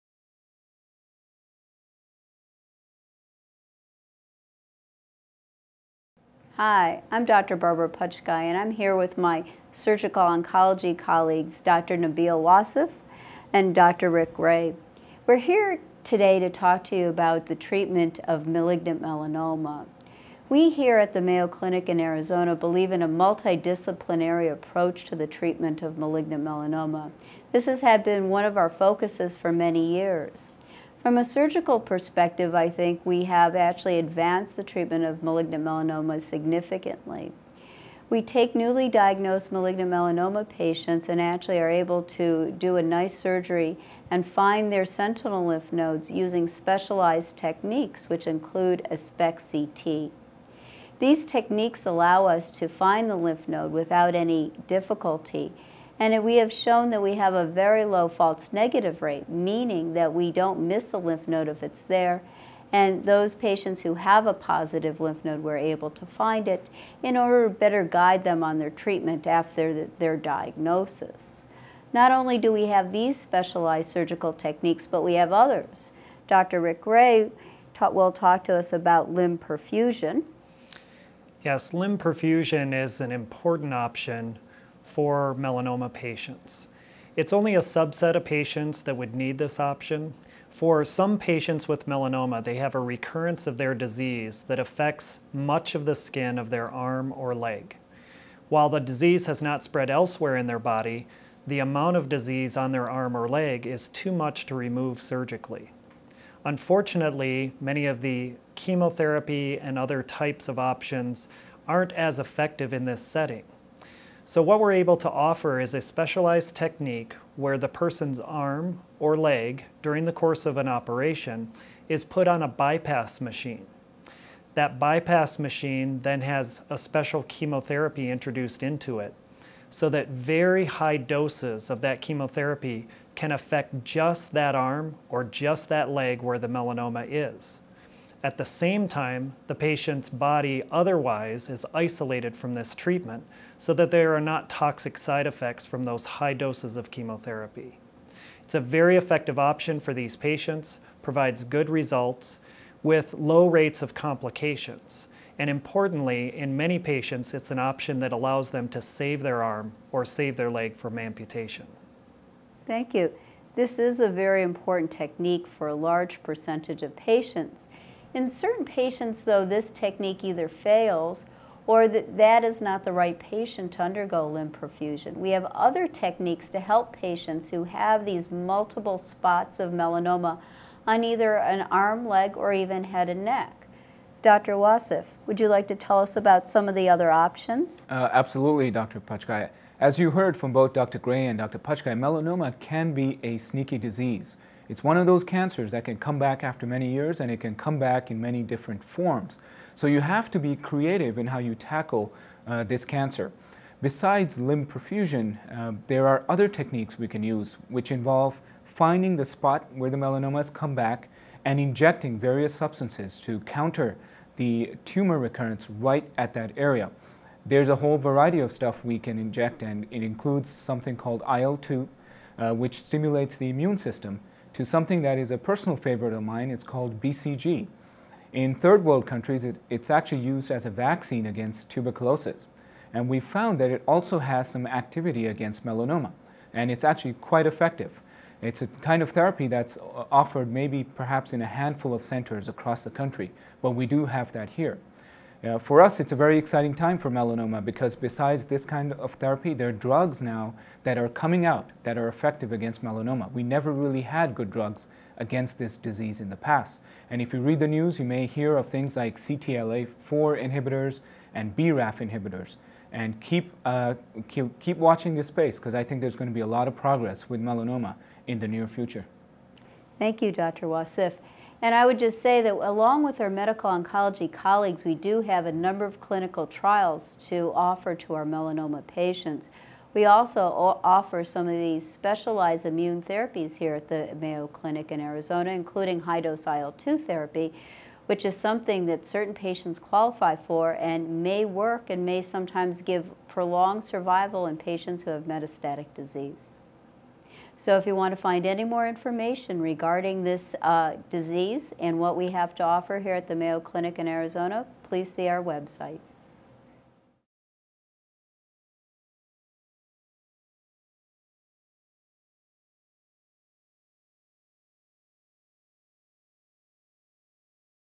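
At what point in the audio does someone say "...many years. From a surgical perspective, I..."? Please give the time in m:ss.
0:29.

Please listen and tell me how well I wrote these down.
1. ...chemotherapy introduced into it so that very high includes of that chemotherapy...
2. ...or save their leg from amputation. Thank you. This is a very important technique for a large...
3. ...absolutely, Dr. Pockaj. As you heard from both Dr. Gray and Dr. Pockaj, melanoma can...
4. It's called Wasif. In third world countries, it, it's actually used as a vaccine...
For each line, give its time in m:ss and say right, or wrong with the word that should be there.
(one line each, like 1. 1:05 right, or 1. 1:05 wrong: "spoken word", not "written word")
1. 2:07 wrong: "doses", not "includes"
2. 2:39 right
3. 3:08 right
4. 3:46 wrong: "BCG", not "Wasif".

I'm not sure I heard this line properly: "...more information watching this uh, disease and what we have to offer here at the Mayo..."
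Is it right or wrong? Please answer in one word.
wrong.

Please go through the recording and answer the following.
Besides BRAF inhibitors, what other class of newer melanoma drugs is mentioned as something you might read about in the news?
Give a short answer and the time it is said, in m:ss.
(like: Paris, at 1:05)
CTLA-4 inhibitors, at 4:19.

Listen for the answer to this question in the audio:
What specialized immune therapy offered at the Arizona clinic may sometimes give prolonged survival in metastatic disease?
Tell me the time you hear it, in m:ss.
4:46.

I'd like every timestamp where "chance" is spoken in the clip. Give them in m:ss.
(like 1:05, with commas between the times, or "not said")
not said.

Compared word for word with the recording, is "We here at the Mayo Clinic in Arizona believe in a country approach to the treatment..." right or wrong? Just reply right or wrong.
wrong.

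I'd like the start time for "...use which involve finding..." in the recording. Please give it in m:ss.
3:27.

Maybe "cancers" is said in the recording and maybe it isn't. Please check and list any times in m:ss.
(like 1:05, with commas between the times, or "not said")
3:15, 3:22.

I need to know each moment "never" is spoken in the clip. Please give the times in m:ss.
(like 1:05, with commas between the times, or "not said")
4:13.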